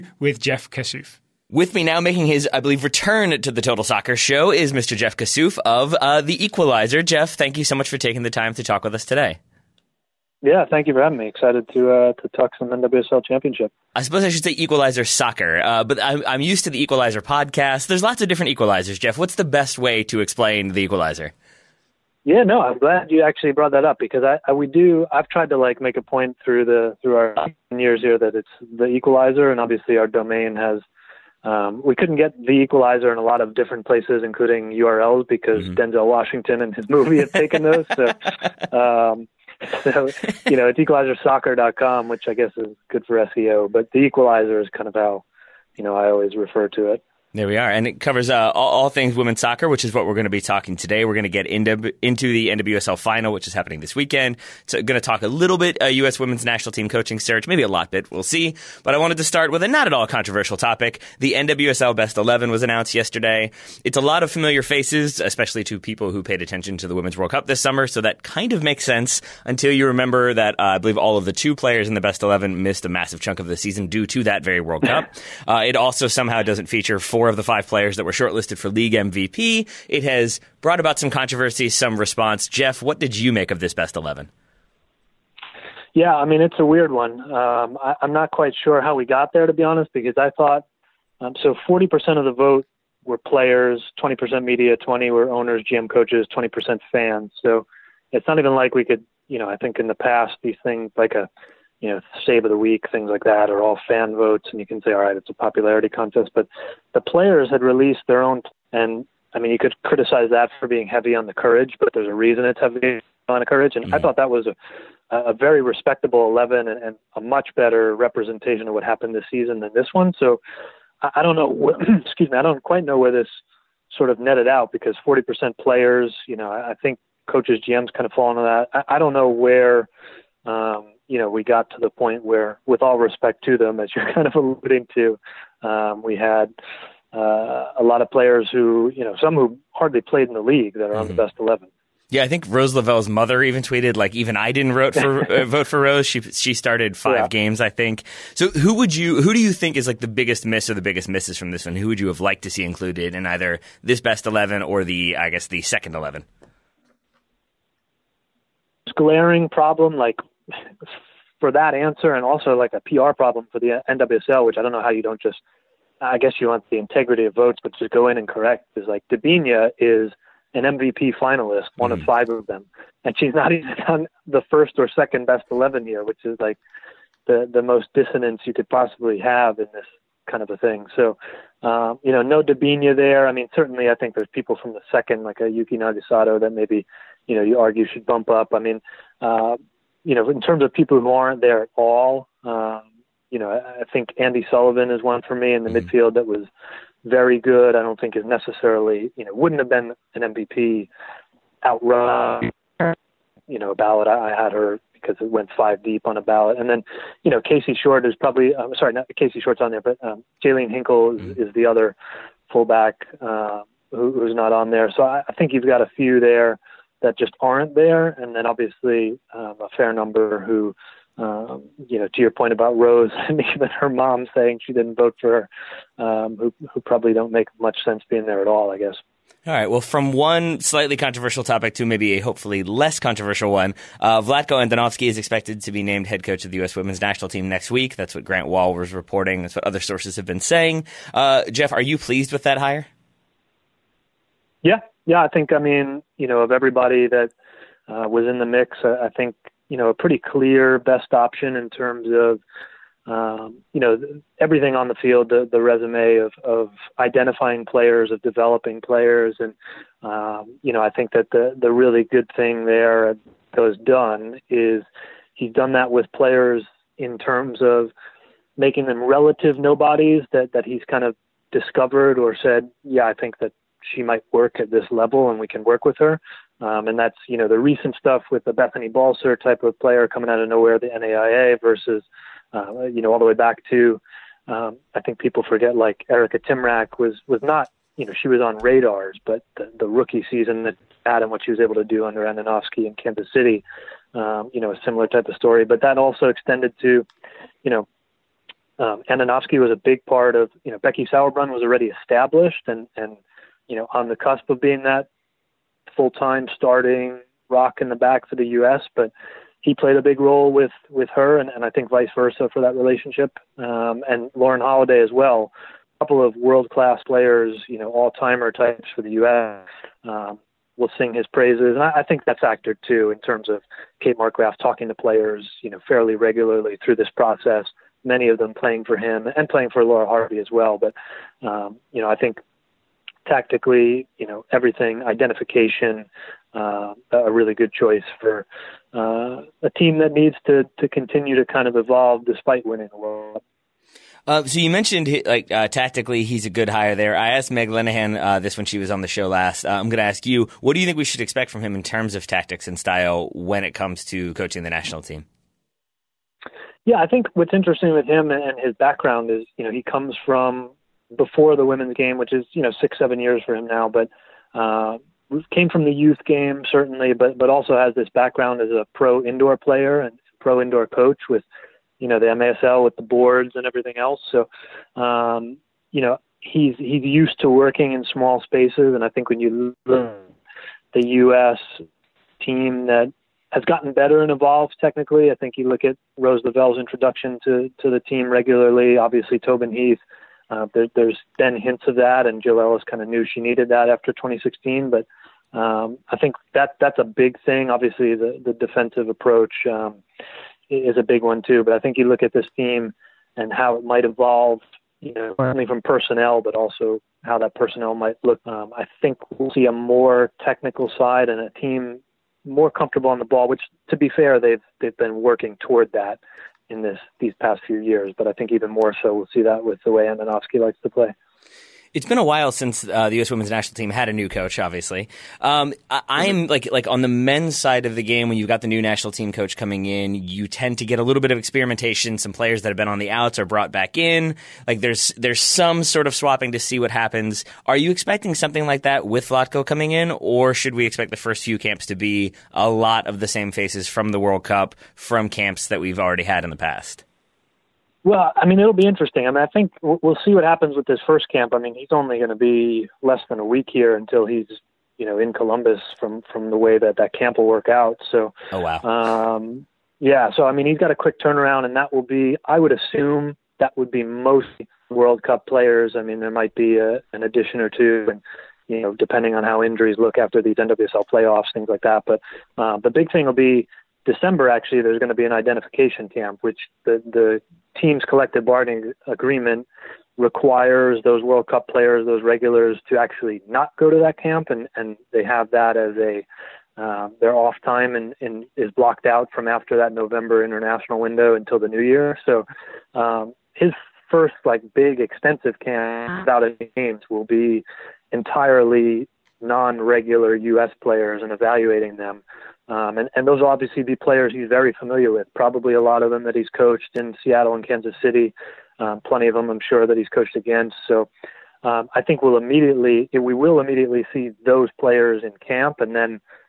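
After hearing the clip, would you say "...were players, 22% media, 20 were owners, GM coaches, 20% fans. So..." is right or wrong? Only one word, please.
wrong.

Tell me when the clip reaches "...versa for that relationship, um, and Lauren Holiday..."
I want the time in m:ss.
5:12.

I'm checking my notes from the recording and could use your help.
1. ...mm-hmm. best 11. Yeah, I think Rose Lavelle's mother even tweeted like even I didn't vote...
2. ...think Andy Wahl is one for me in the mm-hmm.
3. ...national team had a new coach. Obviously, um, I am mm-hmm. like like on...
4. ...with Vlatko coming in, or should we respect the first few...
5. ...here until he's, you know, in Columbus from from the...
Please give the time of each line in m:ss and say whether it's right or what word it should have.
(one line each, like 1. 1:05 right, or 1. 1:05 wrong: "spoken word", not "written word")
1. 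2:21 right
2. 3:13 wrong: "Sullivan", not "Wahl"
3. 7:03 right
4. 7:19 wrong: "expect", not "respect"
5. 7:33 right.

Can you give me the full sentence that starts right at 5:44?
Uh, so you mentioned like uh, tactically, he's a good hire there.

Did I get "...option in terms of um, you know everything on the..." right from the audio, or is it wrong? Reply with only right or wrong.
right.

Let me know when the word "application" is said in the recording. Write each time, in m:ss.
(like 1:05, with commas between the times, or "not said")
not said.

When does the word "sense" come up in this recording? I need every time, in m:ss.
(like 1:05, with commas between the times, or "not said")
1:08, 3:47.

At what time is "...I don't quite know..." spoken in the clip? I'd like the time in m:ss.
2:02.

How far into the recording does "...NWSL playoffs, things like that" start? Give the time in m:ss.
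7:50.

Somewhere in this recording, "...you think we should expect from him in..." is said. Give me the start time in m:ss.
5:50.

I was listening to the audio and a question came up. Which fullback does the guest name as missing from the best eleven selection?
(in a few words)
Jaelene Hinkle.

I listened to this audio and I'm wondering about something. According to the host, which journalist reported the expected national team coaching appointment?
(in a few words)
Grant Wahl.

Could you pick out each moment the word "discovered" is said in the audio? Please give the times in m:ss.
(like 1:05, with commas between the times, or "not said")
4:31.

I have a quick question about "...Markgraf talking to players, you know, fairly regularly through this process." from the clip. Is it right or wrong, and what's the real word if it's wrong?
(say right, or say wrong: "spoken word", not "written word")
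right.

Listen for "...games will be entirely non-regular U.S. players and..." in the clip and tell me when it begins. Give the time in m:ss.
8:16.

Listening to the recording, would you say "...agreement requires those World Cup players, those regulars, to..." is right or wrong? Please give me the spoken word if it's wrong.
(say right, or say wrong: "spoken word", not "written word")
right.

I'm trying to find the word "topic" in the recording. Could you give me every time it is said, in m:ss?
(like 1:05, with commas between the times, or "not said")
1:00, 3:51.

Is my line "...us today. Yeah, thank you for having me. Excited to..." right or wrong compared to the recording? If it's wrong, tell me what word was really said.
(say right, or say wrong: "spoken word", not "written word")
right.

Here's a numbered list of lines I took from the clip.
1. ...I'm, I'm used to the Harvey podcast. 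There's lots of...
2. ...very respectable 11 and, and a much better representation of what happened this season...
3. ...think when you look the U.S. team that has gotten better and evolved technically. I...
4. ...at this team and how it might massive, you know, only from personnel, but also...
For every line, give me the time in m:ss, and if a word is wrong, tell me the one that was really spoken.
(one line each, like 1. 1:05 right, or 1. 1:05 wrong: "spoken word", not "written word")
1. 0:16 wrong: "Equalizer", not "Harvey"
2. 1:55 right
3. 6:19 right
4. 6:42 wrong: "evolve", not "massive".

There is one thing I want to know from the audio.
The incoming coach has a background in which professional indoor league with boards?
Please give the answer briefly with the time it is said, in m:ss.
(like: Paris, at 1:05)
MASL, at 6:12.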